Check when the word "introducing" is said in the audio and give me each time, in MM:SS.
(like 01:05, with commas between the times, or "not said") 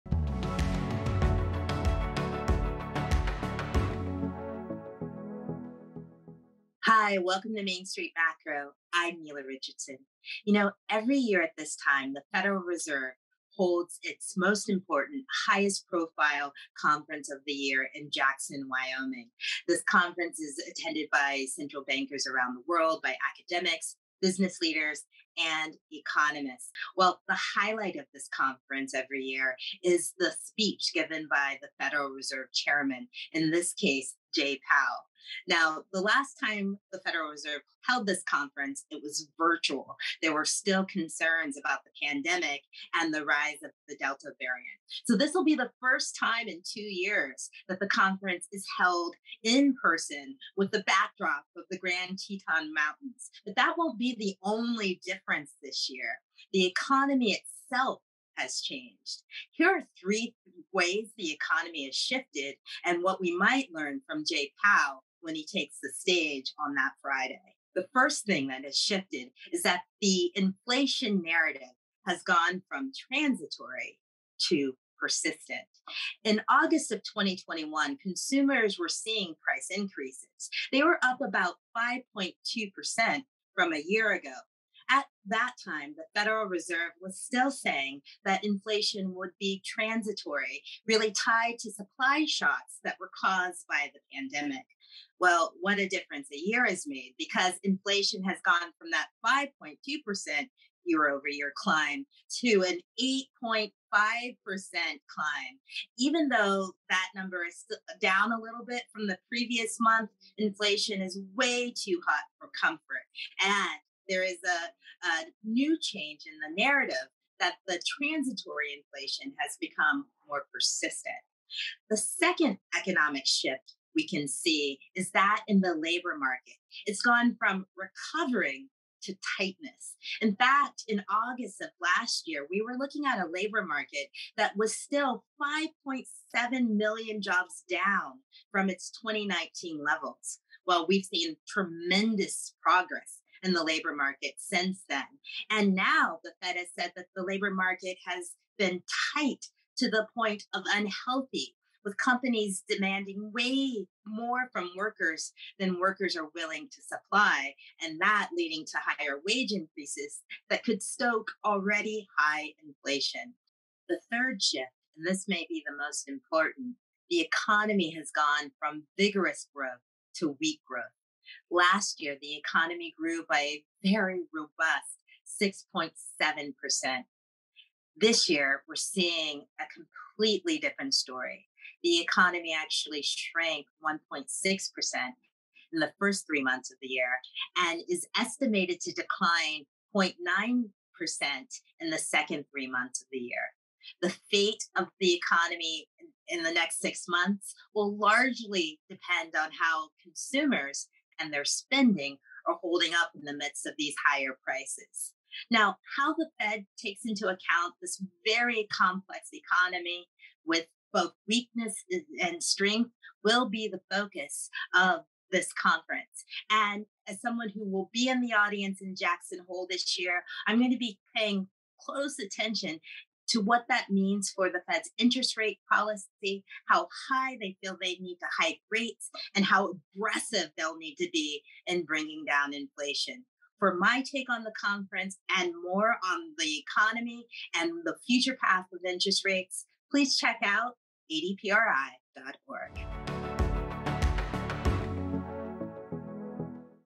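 not said.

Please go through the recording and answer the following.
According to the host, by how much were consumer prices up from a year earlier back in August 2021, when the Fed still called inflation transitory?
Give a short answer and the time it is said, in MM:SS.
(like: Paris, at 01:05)
5.2%, at 01:21.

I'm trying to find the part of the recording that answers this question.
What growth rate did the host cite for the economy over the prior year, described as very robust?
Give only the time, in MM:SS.
02:55.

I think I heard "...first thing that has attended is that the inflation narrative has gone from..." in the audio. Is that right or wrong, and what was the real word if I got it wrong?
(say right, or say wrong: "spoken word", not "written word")
wrong: "shifted", not "attended".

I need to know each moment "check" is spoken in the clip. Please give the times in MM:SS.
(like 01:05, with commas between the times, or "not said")
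04:00.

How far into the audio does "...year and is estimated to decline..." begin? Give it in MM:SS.
03:06.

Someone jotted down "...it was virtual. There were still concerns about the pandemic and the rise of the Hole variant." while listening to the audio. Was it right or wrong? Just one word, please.
wrong.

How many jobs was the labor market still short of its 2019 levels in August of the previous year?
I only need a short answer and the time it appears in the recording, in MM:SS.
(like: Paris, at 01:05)
5.7 million, at 02:15.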